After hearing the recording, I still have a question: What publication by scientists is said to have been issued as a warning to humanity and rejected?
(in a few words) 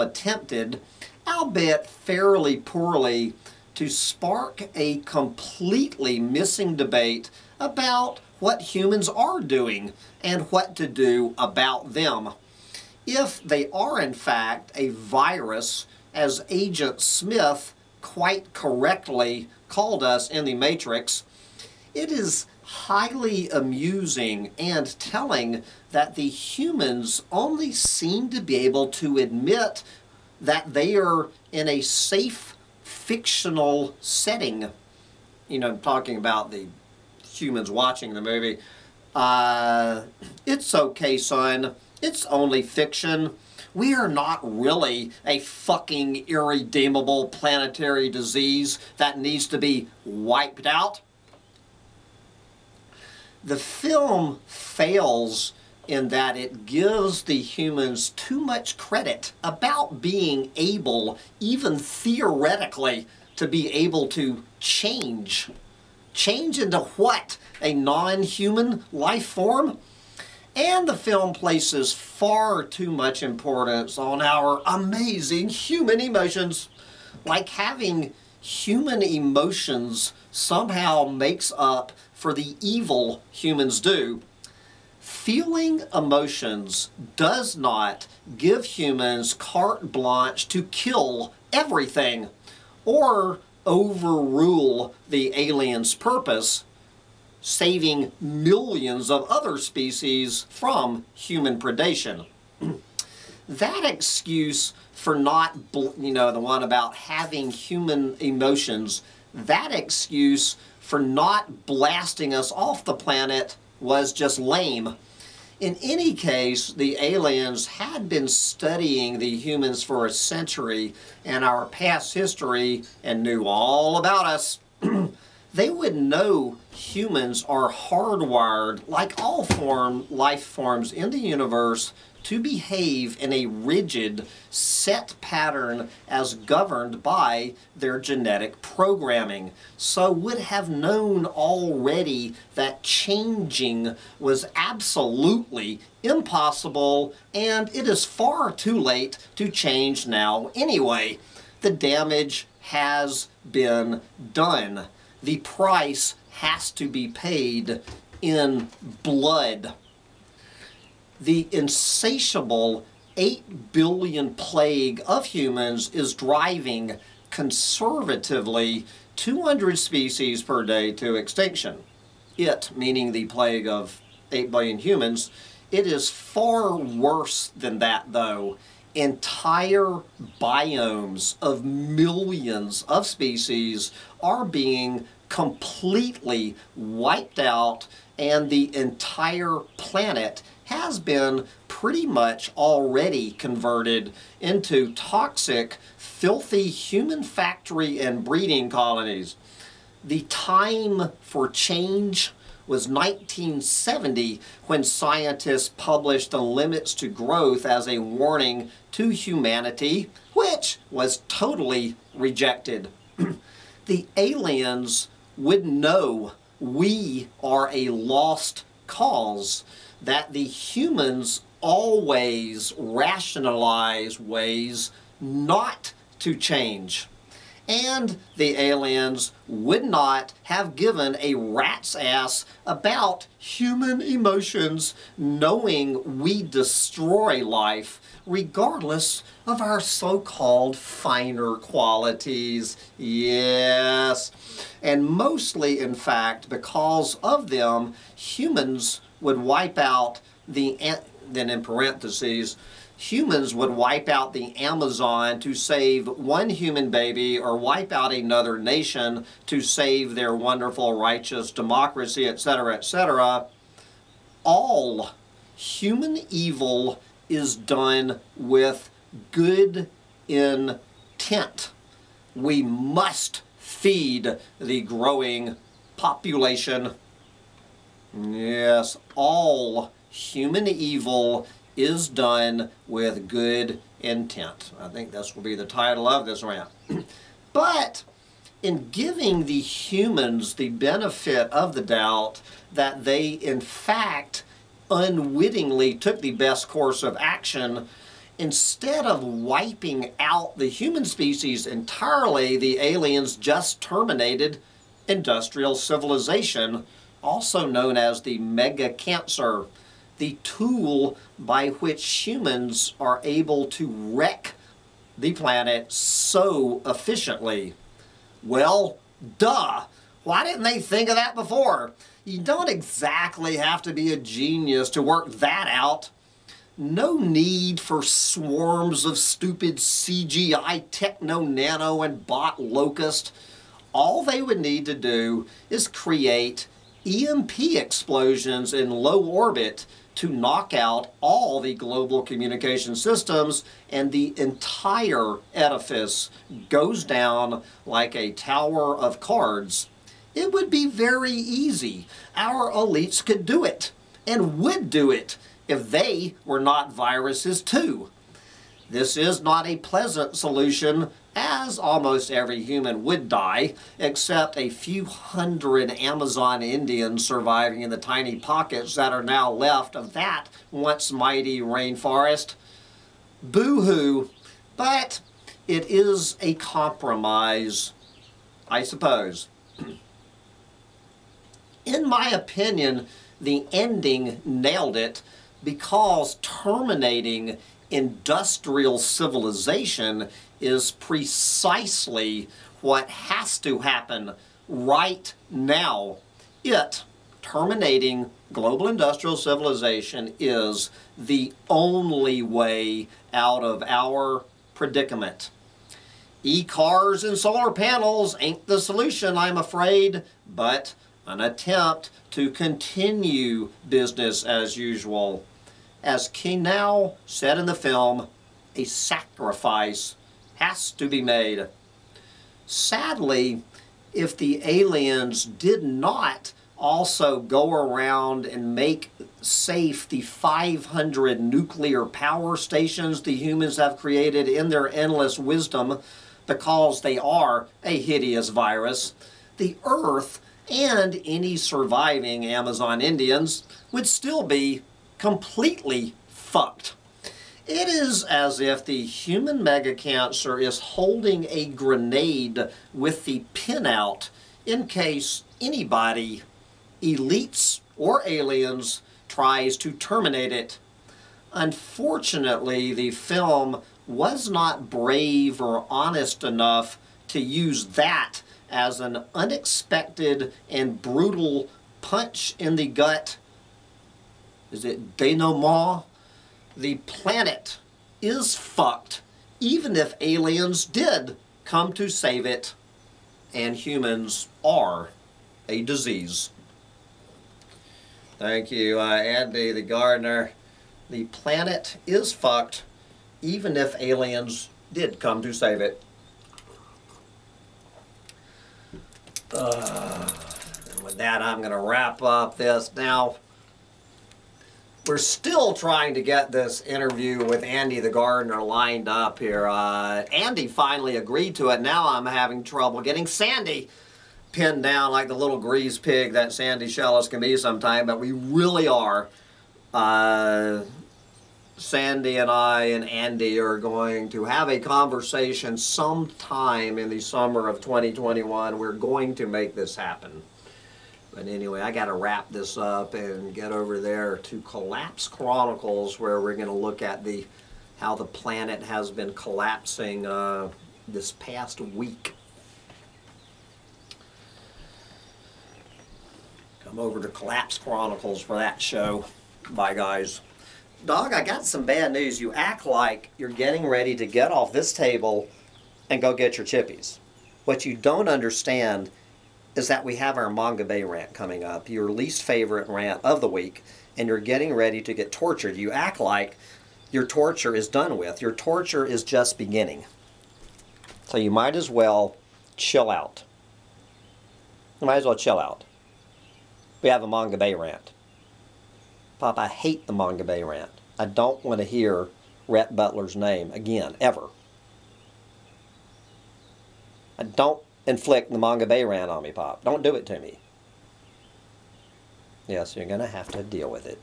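The Limits to Growth.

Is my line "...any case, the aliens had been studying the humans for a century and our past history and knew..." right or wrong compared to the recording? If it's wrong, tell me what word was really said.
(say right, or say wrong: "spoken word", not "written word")
right.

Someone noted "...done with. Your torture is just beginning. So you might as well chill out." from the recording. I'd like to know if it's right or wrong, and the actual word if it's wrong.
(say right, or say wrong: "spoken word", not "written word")
right.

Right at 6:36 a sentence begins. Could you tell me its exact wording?
It terminating global industrial civilization is the only way out of our predicament.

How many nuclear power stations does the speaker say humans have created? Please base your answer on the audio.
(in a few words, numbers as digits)
500.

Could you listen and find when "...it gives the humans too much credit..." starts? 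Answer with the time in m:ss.
0:56.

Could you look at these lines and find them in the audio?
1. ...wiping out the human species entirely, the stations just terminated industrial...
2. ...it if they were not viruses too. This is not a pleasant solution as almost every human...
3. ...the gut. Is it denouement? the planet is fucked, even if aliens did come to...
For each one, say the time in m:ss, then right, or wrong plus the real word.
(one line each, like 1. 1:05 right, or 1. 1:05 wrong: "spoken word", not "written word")
1. 4:59 wrong: "aliens", not "stations"
2. 5:55 right
3. 7:52 right.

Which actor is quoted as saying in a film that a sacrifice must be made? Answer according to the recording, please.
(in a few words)
Keanu.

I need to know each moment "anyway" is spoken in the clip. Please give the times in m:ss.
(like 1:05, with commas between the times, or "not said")
2:30, 8:51.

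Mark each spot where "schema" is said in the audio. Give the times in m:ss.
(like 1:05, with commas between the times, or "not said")
not said.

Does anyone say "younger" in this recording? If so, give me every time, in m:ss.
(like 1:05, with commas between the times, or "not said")
not said.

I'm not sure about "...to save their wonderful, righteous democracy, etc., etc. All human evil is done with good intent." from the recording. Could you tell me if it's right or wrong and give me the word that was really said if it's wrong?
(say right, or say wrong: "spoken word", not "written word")
right.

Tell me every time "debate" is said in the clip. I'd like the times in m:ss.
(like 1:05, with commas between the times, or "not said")
0:06.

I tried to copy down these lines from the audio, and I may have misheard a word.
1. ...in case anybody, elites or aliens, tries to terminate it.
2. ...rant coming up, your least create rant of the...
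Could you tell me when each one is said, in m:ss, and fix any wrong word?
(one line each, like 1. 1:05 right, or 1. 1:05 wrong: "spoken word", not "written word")
1. 7:34 right
2. 9:21 wrong: "favorite", not "create".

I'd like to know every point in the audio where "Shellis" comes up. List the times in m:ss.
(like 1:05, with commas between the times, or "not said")
8:36.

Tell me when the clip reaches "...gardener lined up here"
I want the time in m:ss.
8:28.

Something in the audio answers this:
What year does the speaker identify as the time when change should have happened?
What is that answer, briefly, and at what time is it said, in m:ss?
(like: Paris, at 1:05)
1970, at 3:22.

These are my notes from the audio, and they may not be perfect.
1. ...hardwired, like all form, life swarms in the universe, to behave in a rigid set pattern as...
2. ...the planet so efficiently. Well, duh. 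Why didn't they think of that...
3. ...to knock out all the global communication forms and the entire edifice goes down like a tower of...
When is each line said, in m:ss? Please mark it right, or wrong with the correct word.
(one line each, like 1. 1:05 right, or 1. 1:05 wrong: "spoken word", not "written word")
1. 2:07 wrong: "forms", not "swarms"
2. 5:15 right
3. 5:40 wrong: "systems", not "forms".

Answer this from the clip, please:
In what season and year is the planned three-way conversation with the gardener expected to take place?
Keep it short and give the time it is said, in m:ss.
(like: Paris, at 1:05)
summer of 2021, at 8:47.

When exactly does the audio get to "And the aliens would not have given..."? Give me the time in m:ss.
3:47.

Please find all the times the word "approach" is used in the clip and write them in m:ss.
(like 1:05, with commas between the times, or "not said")
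not said.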